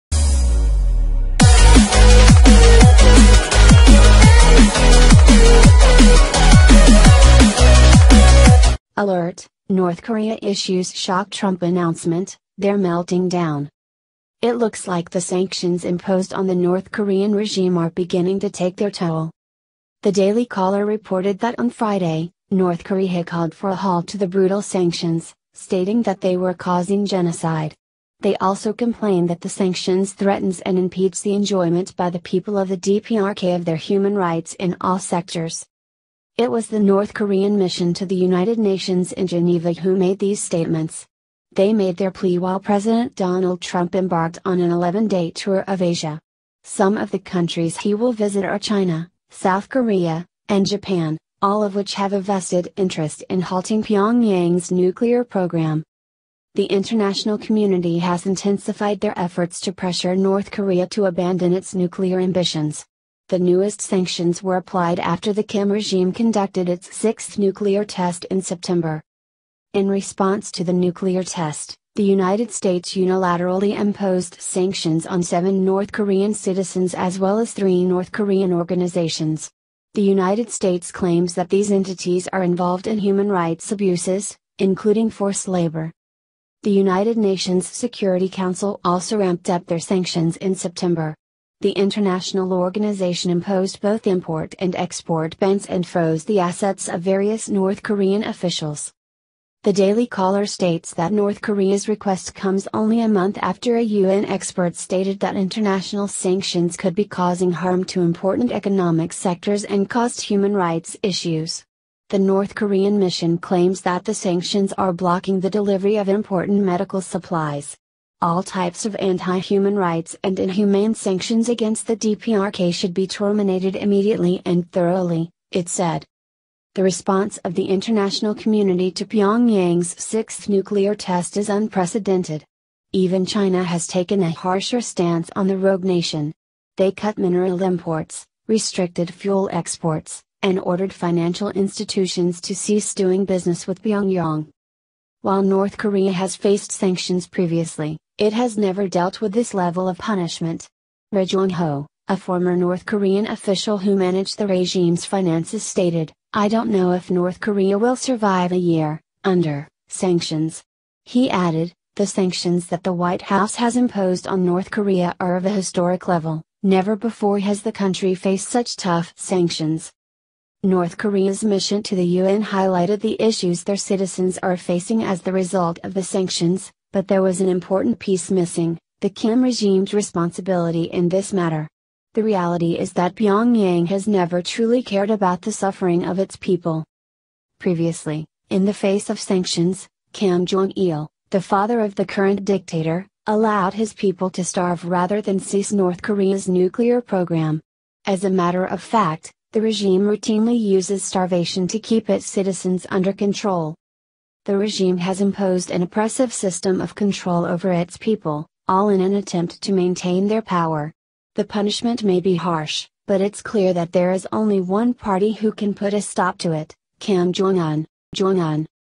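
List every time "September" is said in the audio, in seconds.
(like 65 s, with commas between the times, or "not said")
68 s, 90 s.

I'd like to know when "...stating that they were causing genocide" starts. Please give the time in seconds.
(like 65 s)
25 s.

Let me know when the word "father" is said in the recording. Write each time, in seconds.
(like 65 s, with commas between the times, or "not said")
191 s.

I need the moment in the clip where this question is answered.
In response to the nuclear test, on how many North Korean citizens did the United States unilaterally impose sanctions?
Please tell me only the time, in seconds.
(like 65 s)
75 s.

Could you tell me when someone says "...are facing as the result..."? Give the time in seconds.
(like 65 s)
174 s.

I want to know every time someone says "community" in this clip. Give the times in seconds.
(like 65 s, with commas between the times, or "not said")
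57 s, 128 s.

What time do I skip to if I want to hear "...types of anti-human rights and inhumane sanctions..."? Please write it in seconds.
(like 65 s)
118 s.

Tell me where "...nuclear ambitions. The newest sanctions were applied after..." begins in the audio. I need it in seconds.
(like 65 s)
61 s.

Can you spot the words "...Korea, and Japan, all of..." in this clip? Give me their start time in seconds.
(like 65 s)
49 s.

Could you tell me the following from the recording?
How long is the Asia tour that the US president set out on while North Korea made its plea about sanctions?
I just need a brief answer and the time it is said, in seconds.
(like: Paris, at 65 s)
11 days, at 44 s.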